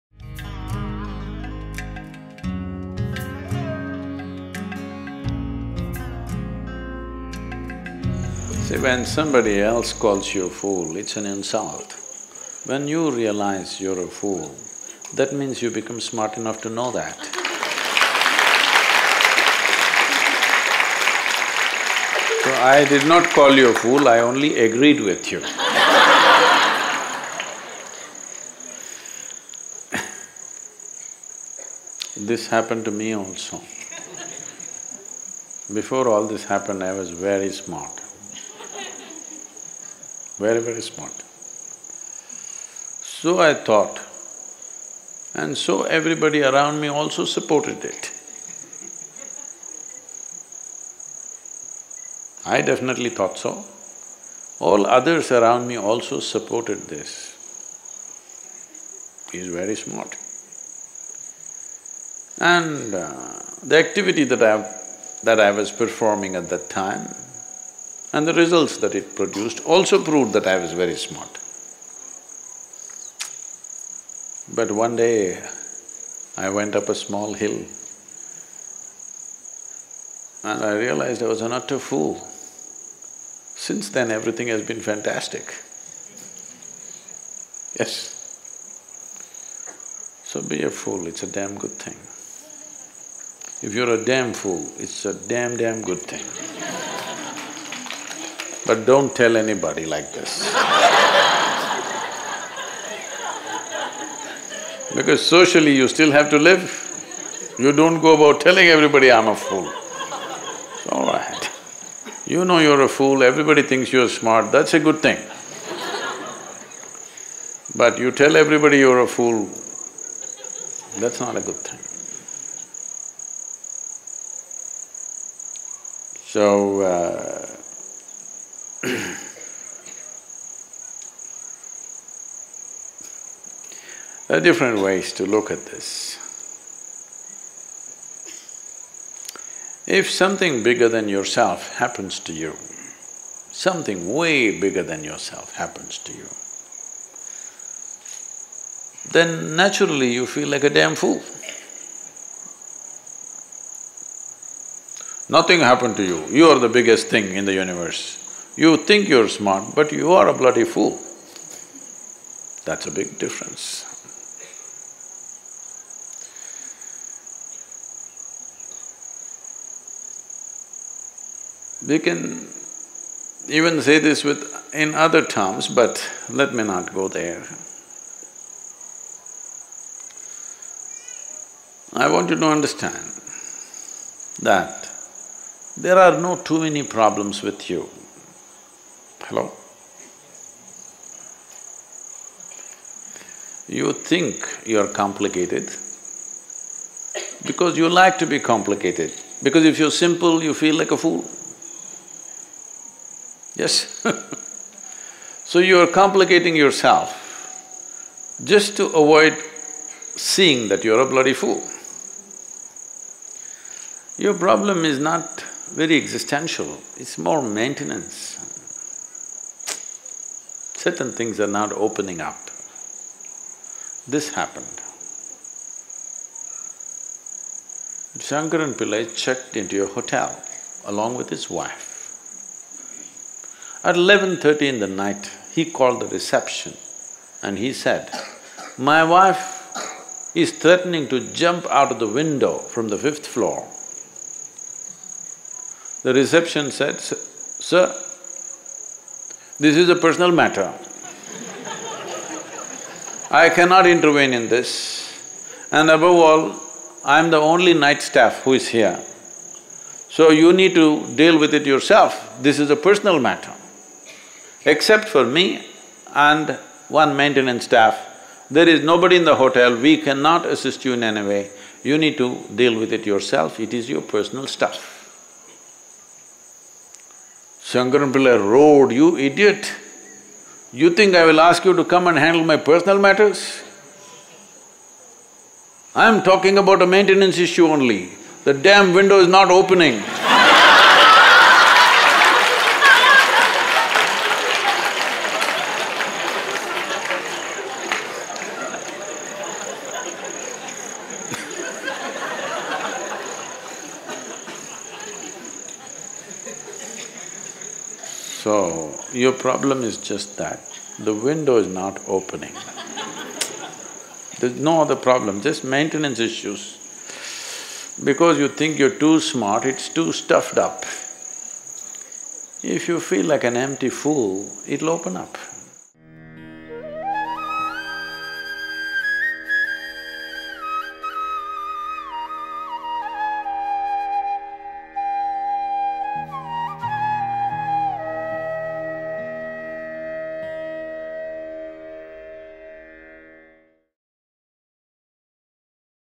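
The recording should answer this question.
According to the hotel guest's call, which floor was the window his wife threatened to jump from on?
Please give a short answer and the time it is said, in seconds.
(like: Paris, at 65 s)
fifth floor, at 243 s.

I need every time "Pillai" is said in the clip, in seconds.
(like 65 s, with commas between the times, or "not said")
228 s, 278 s.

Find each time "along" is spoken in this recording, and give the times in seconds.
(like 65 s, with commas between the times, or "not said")
230 s.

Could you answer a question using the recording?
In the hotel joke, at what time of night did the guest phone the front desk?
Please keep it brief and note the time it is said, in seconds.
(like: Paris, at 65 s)
11.30, at 233 s.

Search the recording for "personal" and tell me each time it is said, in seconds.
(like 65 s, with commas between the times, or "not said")
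249 s, 262 s, 274 s, 282 s.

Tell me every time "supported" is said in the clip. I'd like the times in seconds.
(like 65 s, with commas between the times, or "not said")
47 s, 56 s.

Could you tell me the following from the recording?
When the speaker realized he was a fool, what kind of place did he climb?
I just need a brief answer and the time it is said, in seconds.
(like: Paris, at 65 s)
a small hill, at 76 s.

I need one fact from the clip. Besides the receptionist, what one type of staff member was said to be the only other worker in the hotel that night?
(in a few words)
maintenance staff.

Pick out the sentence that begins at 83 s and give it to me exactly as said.
Since then, everything has been fantastic.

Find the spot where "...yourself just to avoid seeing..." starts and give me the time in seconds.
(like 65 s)
206 s.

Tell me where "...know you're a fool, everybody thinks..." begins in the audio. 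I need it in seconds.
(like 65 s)
112 s.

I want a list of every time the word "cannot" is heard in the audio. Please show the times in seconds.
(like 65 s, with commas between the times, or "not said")
253 s, 269 s.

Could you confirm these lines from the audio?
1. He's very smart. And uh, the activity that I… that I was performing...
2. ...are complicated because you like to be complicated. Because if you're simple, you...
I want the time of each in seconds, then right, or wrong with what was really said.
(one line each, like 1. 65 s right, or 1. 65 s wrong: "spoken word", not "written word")
1. 59 s right
2. 194 s right.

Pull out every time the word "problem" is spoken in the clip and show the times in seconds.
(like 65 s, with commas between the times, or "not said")
186 s, 214 s, 309 s, 314 s.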